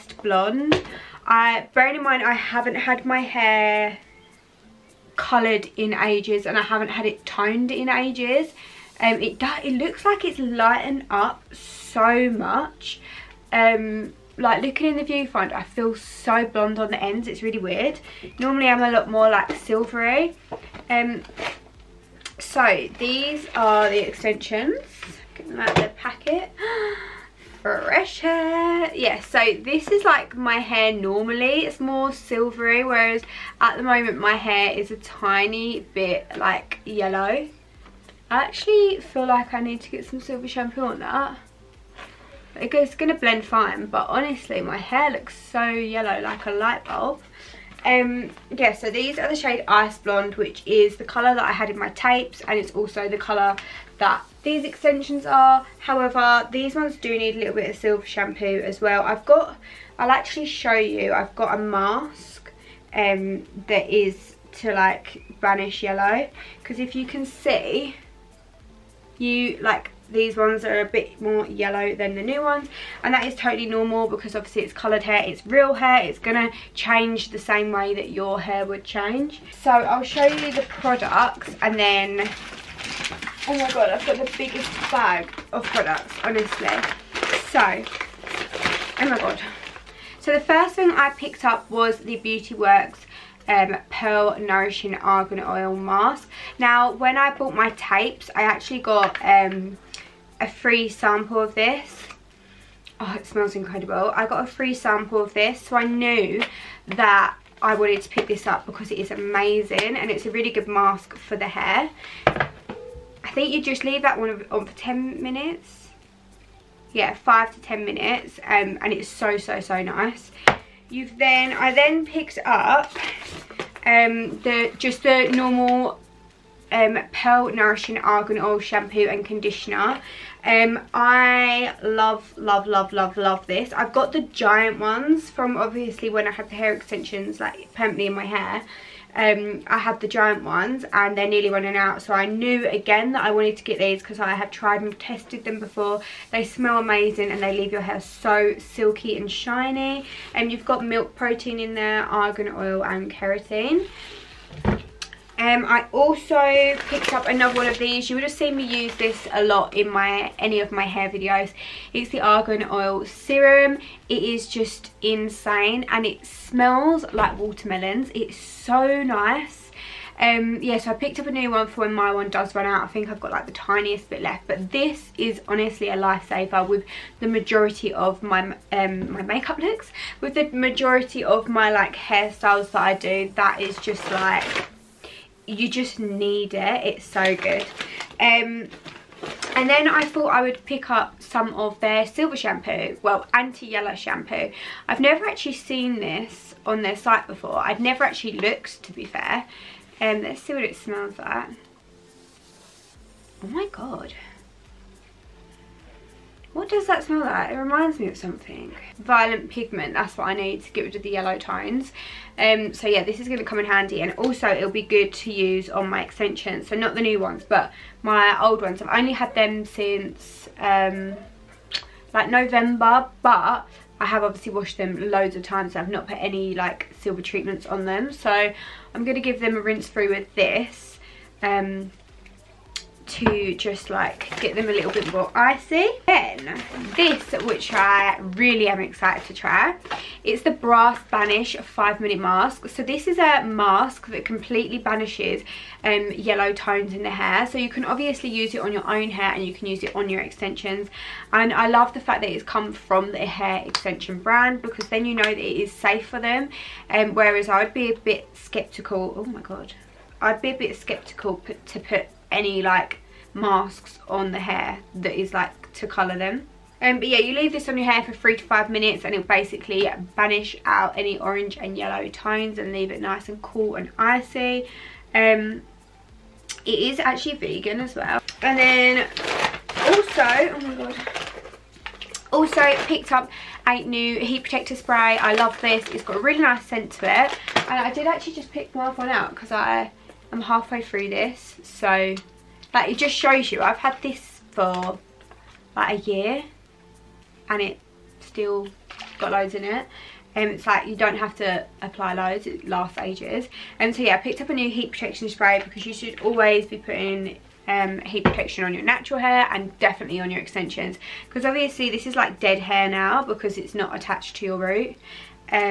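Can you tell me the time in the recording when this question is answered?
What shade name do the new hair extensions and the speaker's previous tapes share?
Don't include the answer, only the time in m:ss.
0:49.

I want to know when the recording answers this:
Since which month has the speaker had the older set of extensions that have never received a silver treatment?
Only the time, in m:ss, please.
3:42.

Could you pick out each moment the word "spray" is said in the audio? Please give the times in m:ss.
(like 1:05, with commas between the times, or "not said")
4:44, 5:05.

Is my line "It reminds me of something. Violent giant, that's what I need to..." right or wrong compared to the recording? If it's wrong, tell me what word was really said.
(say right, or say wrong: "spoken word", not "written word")
wrong: "pigment", not "giant".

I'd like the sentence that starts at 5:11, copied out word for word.
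Because obviously this is like dead hair now because it's not attached to your root.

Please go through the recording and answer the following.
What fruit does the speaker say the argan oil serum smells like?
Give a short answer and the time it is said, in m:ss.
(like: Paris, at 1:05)
watermelons, at 2:47.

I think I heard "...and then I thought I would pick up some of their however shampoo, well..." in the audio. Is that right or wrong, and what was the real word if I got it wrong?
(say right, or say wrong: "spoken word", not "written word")
wrong: "silver", not "however".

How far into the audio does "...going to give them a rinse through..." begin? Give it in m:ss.
3:49.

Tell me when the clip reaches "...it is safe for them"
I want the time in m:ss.
4:15.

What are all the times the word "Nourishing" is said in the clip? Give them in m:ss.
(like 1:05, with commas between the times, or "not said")
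1:34, 2:07.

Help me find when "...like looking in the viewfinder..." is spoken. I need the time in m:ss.
0:14.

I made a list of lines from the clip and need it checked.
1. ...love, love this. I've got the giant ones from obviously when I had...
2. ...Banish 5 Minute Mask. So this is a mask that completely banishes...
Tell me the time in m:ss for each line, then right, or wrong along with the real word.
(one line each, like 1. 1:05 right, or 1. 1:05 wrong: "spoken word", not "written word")
1. 2:12 right
2. 4:01 right.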